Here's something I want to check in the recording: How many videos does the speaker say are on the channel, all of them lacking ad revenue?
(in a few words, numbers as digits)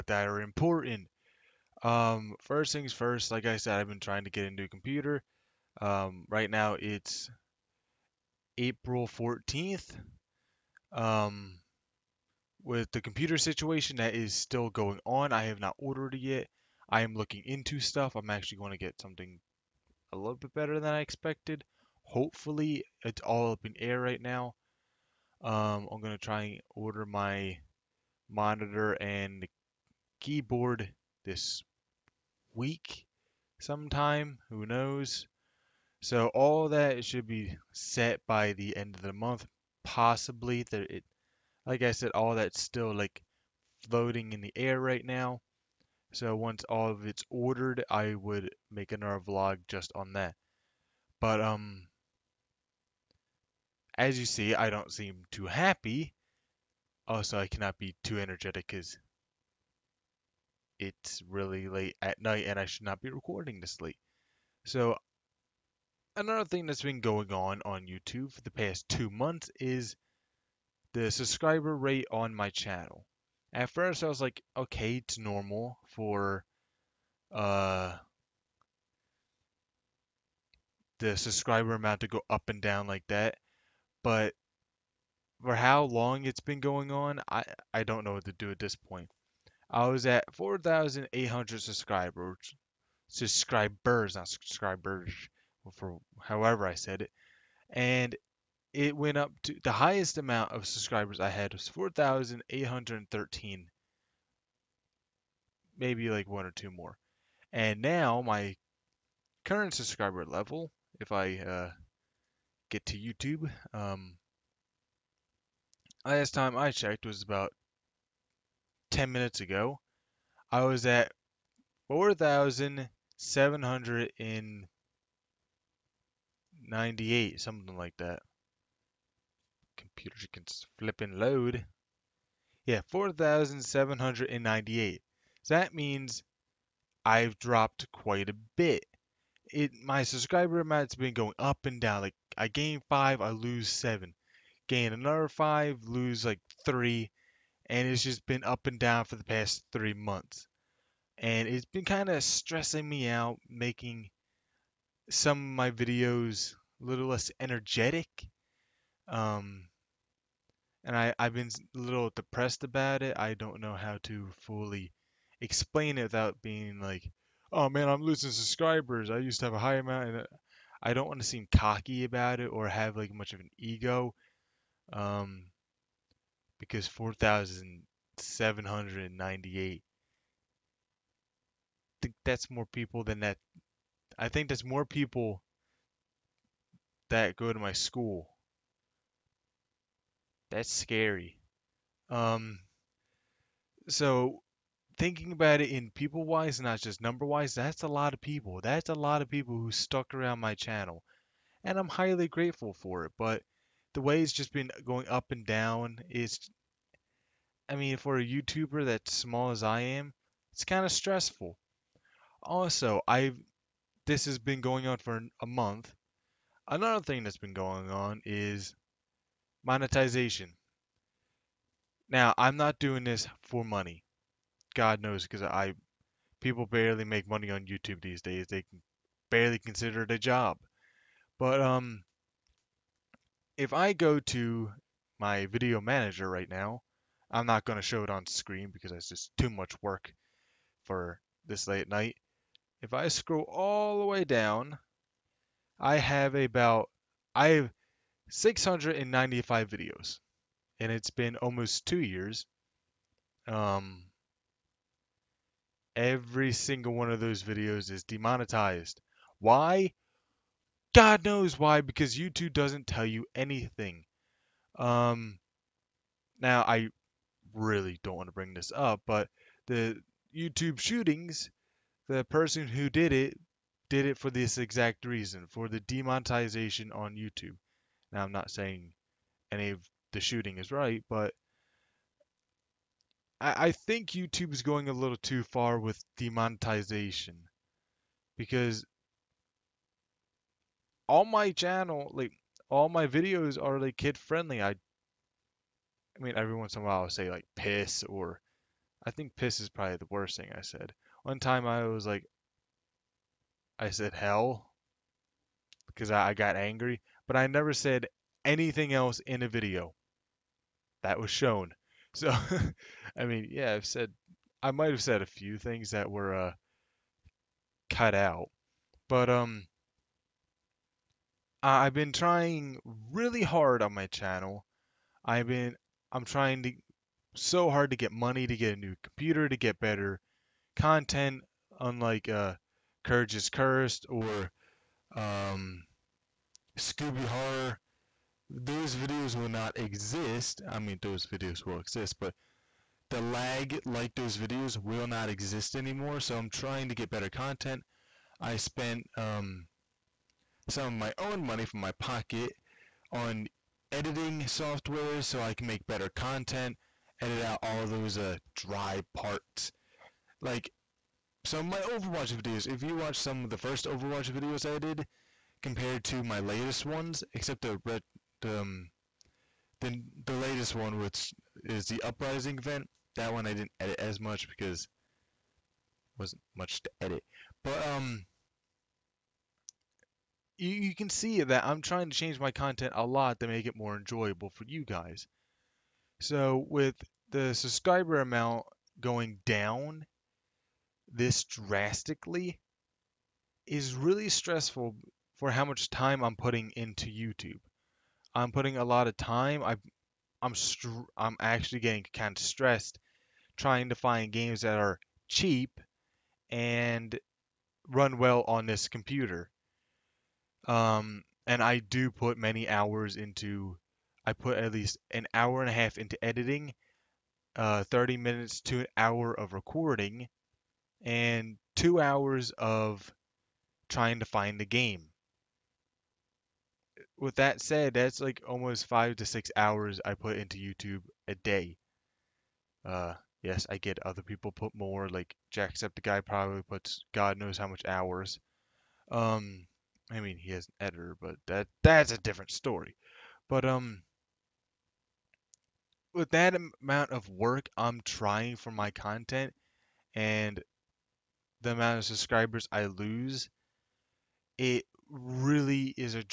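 695.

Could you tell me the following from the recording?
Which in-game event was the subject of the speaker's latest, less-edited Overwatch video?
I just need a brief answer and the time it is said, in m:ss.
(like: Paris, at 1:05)
Uprising, at 6:12.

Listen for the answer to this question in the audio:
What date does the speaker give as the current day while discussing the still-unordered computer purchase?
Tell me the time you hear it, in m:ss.
0:08.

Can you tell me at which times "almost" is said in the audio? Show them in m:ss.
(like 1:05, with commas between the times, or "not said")
4:11, 7:08.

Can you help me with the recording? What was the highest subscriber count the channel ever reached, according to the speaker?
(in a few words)
4,813.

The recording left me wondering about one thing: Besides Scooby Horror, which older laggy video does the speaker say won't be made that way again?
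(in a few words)
Courage is Cursed.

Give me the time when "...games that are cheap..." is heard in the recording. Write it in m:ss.
6:44.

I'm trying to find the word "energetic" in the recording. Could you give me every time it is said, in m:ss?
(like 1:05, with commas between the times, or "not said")
0:58, 2:37.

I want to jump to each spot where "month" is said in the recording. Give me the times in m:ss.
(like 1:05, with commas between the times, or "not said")
0:39, 1:09, 2:29, 3:35.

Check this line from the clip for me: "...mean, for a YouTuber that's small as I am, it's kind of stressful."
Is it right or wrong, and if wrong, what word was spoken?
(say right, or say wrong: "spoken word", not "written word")
right.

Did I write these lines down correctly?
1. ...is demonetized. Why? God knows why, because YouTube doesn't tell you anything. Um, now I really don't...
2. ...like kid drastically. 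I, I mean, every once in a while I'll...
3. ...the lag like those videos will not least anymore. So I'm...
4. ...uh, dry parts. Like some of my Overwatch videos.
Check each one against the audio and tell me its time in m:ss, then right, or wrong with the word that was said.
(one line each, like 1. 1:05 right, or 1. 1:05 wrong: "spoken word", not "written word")
1. 4:17 right
2. 4:53 wrong: "friendly", not "drastically"
3. 5:43 wrong: "exist", not "least"
4. 5:58 right.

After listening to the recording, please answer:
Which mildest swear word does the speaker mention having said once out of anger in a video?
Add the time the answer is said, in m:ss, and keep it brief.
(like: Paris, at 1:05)
hell, at 5:04.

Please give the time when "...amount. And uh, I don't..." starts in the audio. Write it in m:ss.
2:49.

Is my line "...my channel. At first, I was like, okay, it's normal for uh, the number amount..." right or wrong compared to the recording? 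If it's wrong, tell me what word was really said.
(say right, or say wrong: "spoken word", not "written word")
wrong: "subscriber", not "number".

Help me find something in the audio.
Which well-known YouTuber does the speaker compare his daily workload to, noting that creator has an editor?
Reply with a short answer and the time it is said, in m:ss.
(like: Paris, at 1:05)
Jacksepticeye, at 7:15.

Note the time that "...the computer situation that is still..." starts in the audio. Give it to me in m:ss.
0:12.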